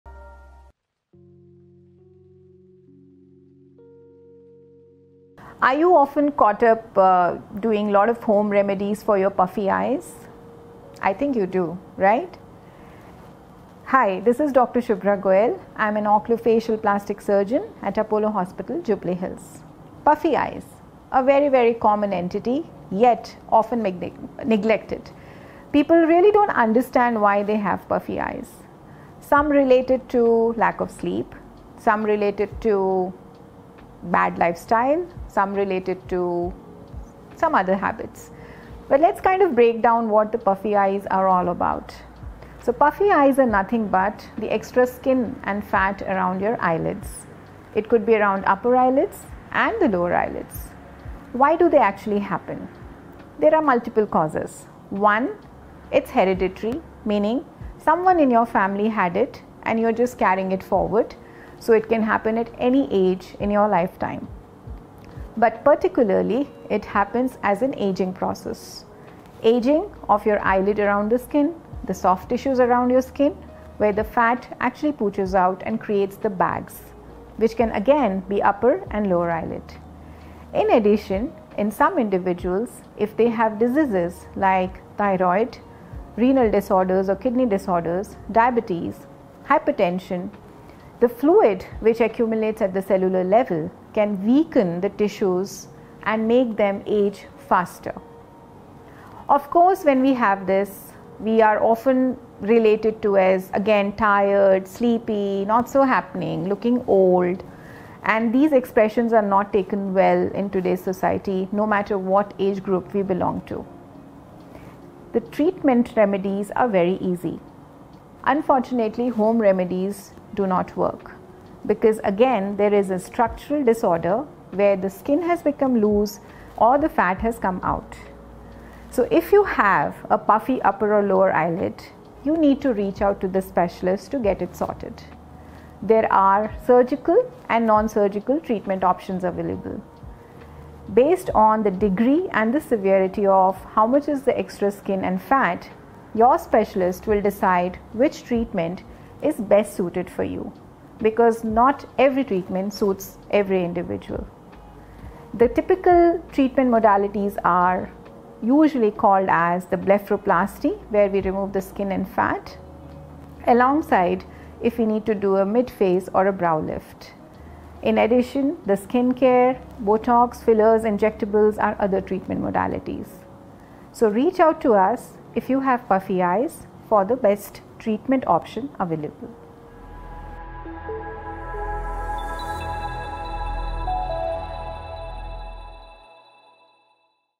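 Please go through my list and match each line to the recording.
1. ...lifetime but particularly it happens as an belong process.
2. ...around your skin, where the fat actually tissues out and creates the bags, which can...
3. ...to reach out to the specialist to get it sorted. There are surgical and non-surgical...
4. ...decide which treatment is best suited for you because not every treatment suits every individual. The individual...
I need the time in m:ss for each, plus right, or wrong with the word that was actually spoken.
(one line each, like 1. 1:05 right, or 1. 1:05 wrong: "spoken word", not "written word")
1. 1:03 wrong: "aging", not "belong"
2. 1:12 wrong: "pooches", not "tissues"
3. 2:12 right
4. 2:27 wrong: "typical", not "individual".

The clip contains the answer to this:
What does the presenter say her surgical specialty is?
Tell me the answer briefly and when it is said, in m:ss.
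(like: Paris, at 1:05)
oculofacial plastic surgeon, at 0:16.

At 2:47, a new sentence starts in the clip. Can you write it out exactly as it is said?
In addition, the skincare, Botox, fillers, injectables are other treatment modalities.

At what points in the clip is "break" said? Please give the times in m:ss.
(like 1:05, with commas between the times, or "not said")
0:39.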